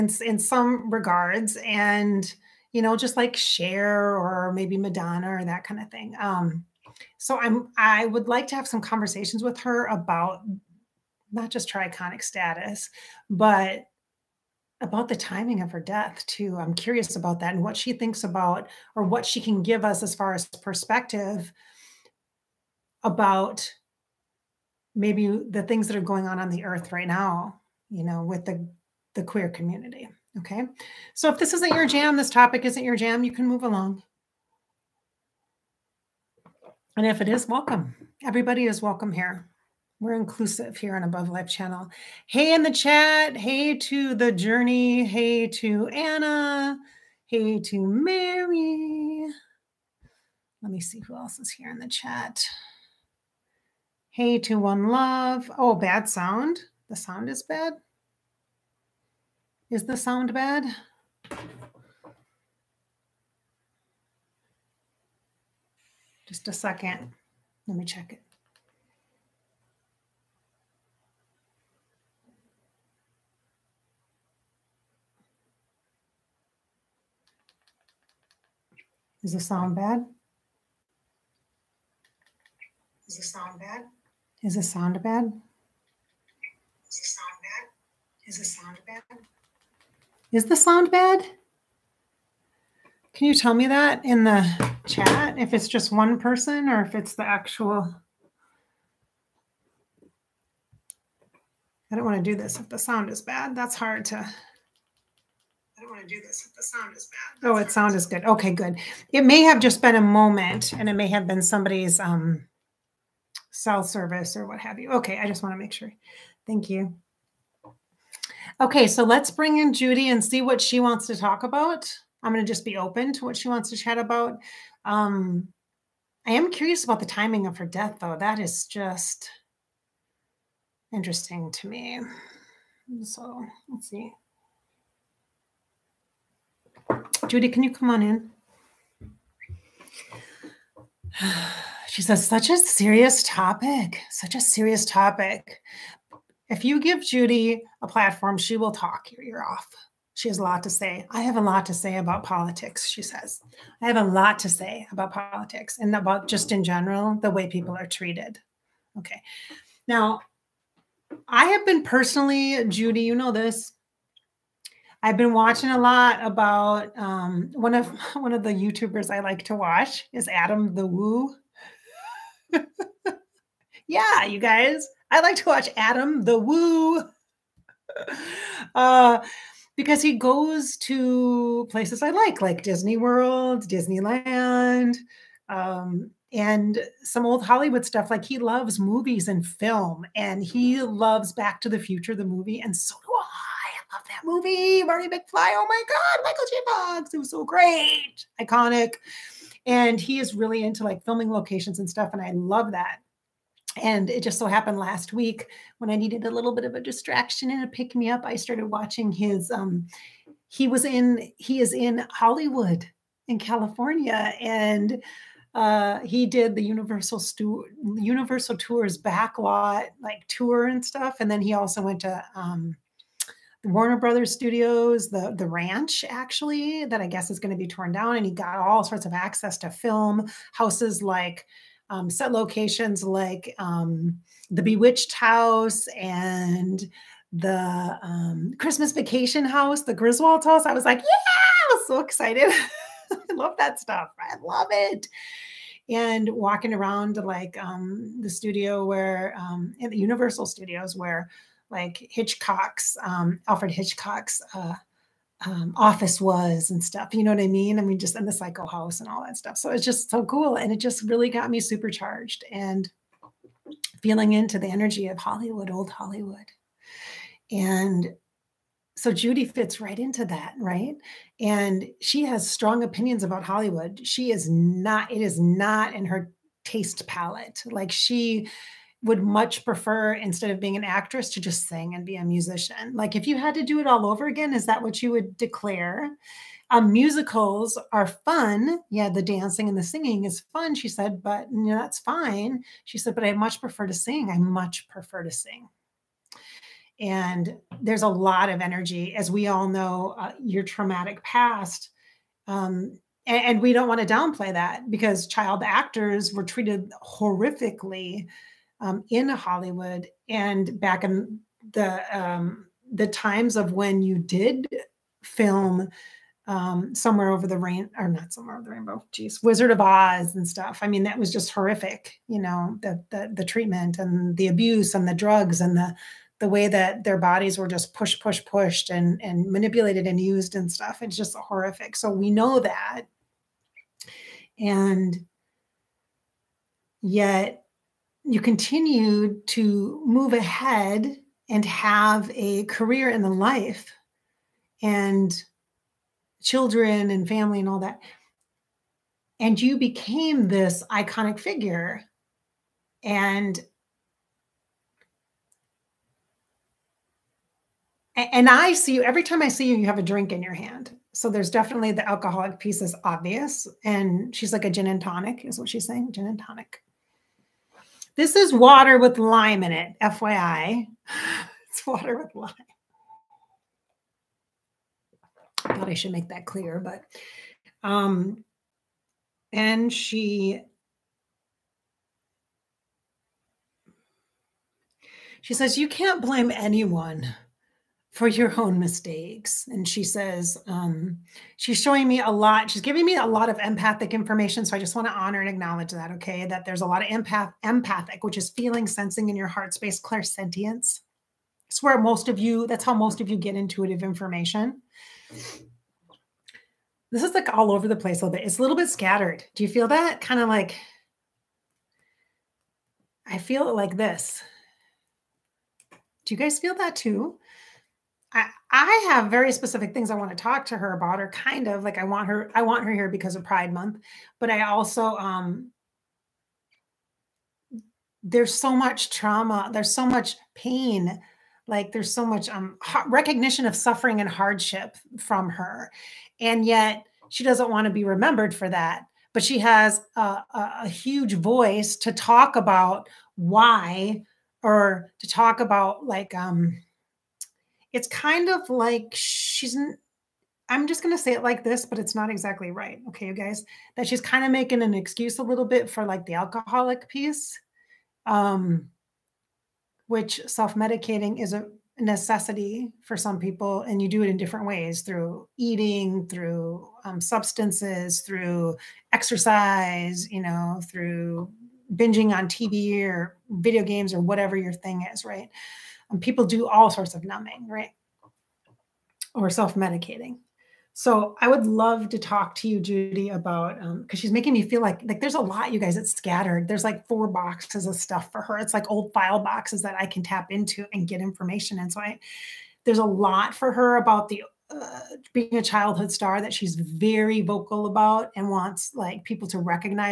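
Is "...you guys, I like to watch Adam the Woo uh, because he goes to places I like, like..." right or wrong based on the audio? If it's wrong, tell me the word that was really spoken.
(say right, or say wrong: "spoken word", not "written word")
right.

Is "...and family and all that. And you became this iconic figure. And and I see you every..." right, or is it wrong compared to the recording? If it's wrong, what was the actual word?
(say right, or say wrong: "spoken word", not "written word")
right.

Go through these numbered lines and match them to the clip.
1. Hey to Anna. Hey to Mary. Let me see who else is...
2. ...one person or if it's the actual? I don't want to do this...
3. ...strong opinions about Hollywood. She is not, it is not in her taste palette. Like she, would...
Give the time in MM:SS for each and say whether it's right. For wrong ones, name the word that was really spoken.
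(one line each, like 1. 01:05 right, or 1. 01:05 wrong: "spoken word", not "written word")
1. 00:45 right
2. 01:35 right
3. 04:32 right.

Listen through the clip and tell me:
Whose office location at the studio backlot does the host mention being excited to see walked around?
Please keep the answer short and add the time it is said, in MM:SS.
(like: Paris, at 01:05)
Alfred Hitchcock, at 04:13.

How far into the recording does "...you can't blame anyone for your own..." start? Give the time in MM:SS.
06:25.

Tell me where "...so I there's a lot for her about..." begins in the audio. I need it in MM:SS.
08:11.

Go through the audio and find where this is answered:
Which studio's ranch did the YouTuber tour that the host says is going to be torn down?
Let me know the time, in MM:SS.
03:43.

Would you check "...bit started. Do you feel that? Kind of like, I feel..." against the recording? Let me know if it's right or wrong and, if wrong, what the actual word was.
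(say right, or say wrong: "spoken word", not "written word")
wrong: "scattered", not "started".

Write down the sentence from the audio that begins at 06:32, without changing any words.
She's giving me a lot of empathic information.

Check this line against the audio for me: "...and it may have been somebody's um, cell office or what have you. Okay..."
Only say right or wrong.
wrong.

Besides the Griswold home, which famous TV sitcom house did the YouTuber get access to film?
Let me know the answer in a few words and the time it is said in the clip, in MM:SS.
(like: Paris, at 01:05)
Bewitched House, at 03:54.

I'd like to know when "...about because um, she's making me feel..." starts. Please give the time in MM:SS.
08:03.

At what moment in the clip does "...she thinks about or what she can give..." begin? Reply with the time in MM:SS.
00:17.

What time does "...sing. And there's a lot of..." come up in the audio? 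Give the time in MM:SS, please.
04:55.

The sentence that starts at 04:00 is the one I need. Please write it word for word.
I was like, yeah, I was so excited.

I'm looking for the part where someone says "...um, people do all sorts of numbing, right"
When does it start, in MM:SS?
07:56.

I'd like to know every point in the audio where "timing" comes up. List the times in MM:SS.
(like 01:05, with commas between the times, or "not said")
00:15, 02:07.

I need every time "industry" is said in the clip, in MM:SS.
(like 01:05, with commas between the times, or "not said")
not said.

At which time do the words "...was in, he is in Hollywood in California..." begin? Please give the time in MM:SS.
03:30.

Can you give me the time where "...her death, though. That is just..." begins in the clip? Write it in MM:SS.
02:07.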